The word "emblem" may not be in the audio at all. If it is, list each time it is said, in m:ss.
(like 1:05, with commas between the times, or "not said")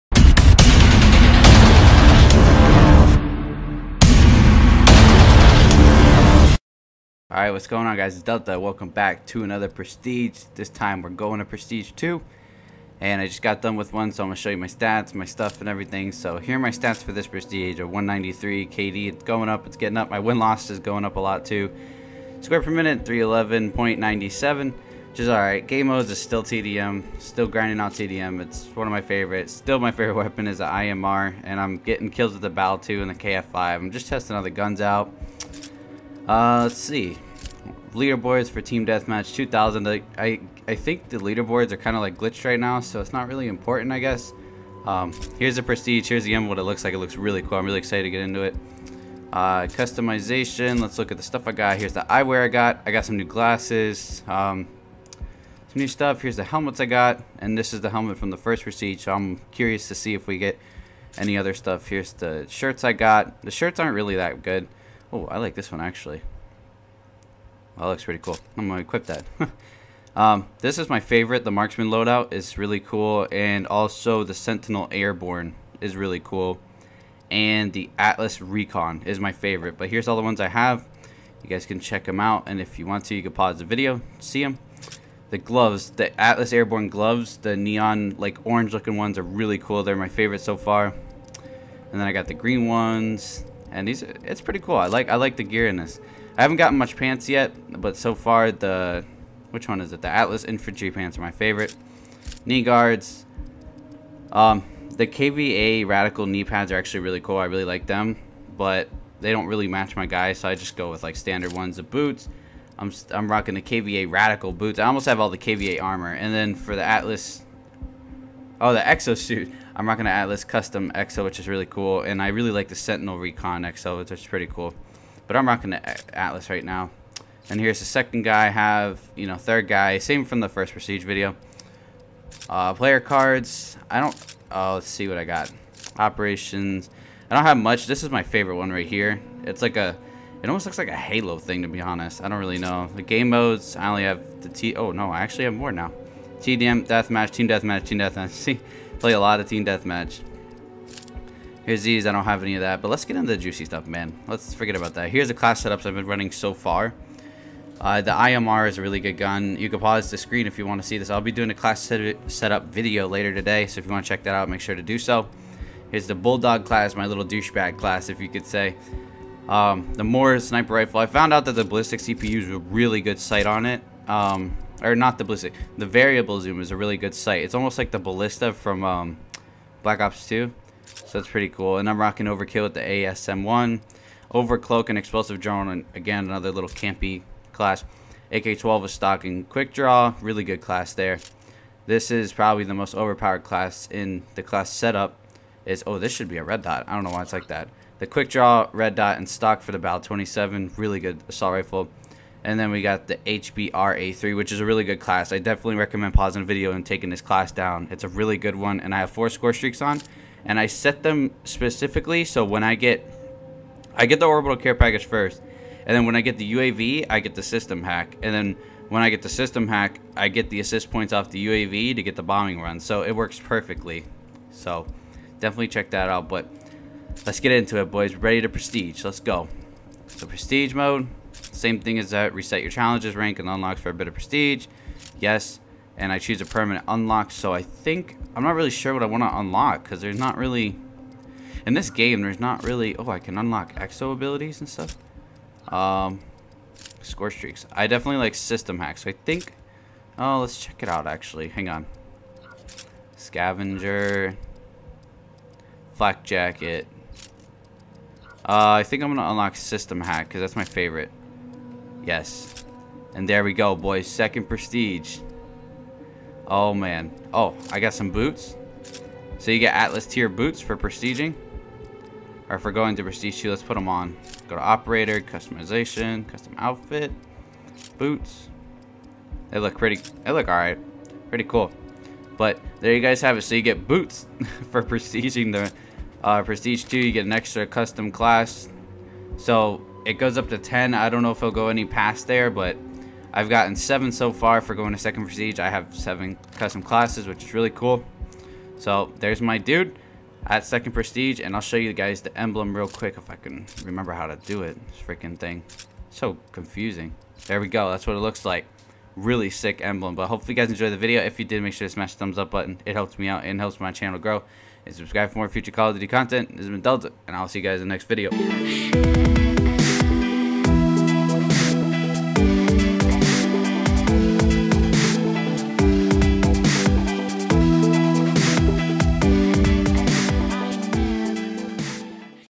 5:02, 5:09.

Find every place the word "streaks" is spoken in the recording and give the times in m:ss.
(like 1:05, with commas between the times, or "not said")
3:29, 4:07.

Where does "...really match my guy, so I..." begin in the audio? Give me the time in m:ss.
1:49.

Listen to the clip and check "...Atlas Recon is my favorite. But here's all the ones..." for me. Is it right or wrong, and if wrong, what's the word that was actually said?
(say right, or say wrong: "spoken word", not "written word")
right.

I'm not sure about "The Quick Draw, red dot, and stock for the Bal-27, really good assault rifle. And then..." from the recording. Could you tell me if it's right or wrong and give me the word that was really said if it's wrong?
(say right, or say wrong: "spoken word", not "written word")
right.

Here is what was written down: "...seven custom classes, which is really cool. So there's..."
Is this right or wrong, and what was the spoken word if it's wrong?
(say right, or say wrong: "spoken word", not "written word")
right.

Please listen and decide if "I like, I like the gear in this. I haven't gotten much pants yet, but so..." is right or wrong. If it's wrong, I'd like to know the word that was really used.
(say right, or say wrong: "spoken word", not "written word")
right.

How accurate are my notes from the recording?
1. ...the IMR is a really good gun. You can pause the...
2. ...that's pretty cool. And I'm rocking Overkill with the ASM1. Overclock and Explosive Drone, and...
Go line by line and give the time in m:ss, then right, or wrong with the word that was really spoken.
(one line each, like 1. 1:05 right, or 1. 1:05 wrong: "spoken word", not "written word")
1. 2:38 right
2. 3:01 right.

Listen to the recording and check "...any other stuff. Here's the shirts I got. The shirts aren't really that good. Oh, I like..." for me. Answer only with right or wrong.
right.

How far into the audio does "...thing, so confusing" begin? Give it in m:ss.
5:05.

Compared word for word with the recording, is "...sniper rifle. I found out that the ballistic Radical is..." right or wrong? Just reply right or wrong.
wrong.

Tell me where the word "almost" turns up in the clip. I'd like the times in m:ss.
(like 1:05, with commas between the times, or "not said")
1:54, 2:20, 2:57.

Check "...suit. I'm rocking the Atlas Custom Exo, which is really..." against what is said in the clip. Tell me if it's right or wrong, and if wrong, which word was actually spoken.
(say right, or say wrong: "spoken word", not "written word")
right.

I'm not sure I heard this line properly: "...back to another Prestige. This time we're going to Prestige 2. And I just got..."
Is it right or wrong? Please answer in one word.
right.